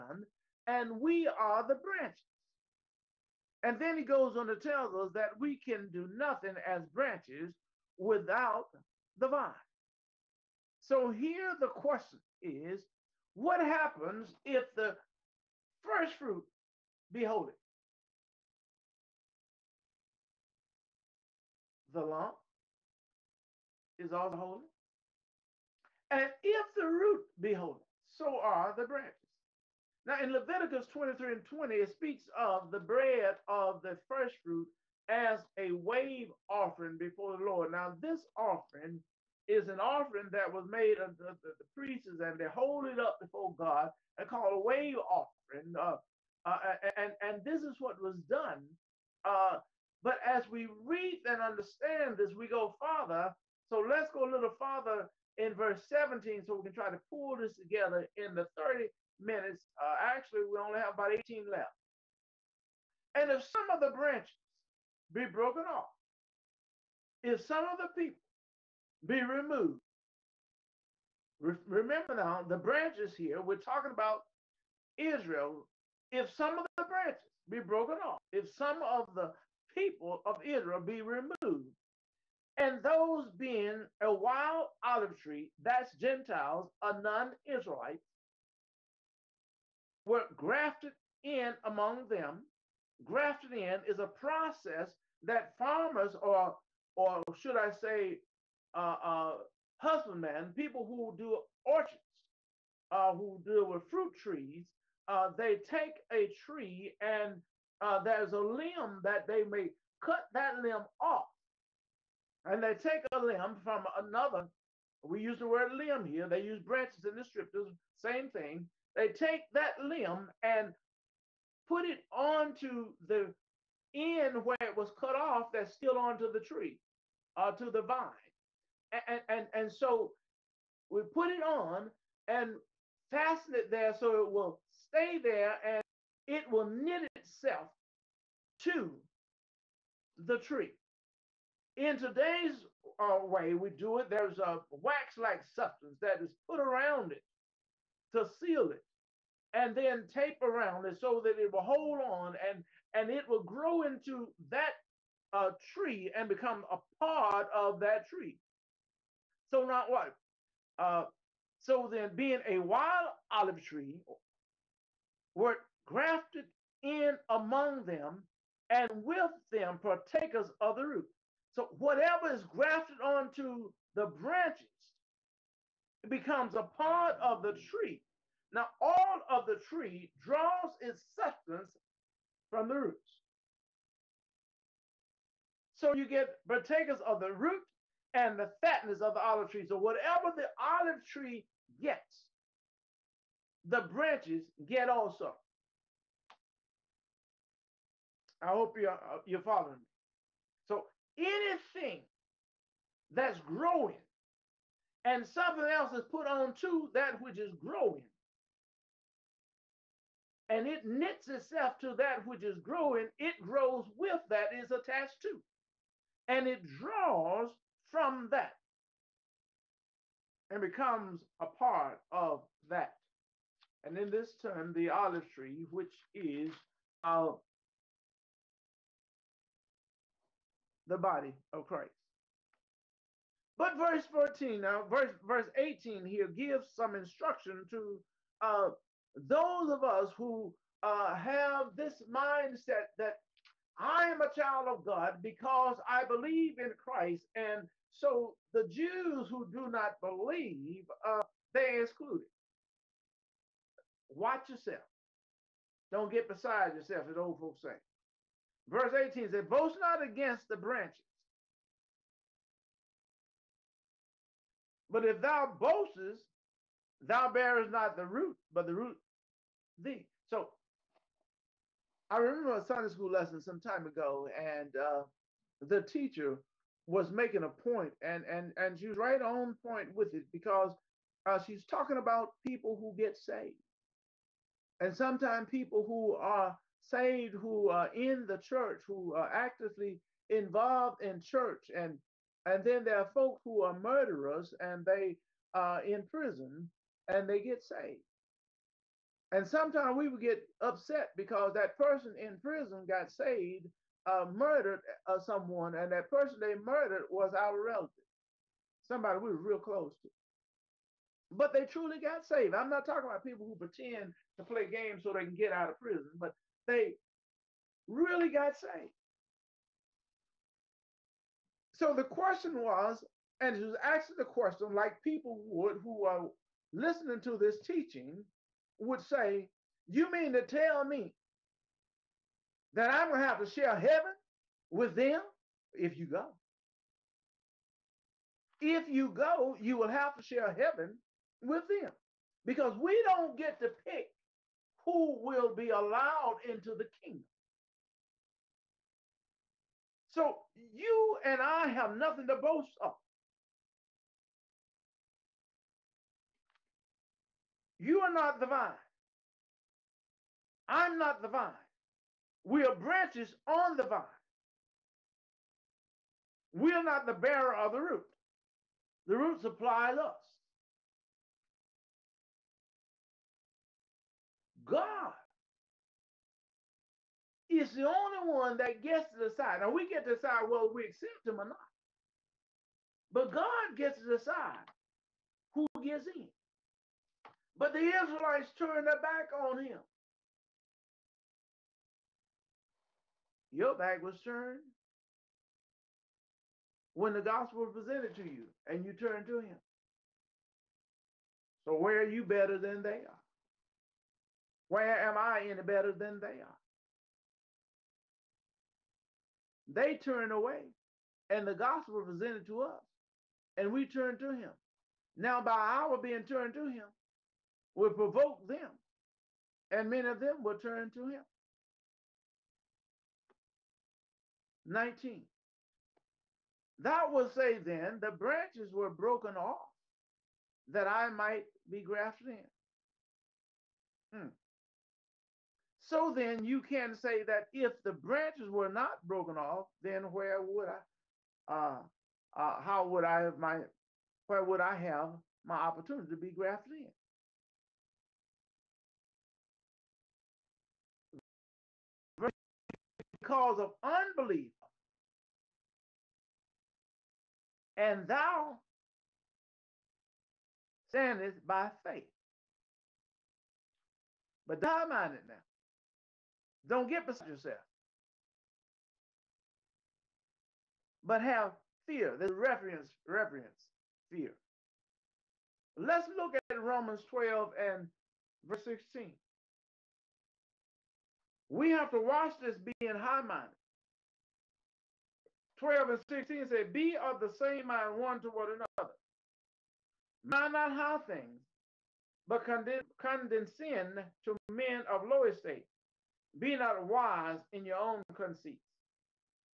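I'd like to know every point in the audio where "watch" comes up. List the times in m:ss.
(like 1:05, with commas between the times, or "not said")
4:14, 8:02.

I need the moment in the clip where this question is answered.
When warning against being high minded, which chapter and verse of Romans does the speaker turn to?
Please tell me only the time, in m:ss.
7:56.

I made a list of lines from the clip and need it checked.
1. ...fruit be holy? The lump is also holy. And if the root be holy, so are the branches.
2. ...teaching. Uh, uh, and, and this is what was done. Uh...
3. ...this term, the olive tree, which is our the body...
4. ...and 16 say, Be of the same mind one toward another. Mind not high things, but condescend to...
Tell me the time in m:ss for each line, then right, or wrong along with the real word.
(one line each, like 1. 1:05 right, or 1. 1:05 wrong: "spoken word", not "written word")
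1. 0:16 right
2. 0:44 wrong: "offering", not "teaching"
3. 3:44 right
4. 8:05 right.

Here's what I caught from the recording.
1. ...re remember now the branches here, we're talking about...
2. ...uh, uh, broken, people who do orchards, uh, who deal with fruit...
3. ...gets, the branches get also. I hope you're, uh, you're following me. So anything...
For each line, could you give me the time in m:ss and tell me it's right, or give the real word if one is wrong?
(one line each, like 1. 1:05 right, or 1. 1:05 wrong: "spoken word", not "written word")
1. 1:11 right
2. 1:38 wrong: "husbandmen", not "broken"
3. 3:11 right.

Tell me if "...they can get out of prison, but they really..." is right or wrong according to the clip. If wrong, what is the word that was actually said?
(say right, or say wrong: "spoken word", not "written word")
right.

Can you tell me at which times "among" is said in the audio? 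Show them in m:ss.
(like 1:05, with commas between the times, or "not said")
1:31, 2:47.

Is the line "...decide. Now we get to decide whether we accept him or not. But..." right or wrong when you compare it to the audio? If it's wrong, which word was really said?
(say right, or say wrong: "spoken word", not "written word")
right.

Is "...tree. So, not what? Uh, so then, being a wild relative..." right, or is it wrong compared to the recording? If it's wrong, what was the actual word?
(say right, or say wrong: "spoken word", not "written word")
wrong: "olive", not "relative".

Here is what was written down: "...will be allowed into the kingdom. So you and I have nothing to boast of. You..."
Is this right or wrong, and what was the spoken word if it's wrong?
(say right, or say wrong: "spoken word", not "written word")
right.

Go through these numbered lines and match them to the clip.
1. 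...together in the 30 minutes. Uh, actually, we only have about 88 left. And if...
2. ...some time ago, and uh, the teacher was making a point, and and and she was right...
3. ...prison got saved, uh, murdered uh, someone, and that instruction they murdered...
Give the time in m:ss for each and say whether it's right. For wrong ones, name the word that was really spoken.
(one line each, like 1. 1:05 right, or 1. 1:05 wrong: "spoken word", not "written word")
1. 0:57 wrong: "18", not "88"
2. 4:33 right
3. 5:02 wrong: "person", not "instruction".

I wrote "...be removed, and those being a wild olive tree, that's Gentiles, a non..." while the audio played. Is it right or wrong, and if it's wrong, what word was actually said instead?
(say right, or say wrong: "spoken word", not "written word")
right.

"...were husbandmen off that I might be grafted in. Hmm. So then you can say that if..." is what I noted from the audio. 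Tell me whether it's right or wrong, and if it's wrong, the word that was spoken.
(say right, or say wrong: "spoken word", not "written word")
wrong: "broken", not "husbandmen".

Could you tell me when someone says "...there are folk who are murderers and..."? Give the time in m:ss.
4:52.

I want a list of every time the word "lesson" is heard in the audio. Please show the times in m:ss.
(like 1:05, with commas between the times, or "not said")
4:33.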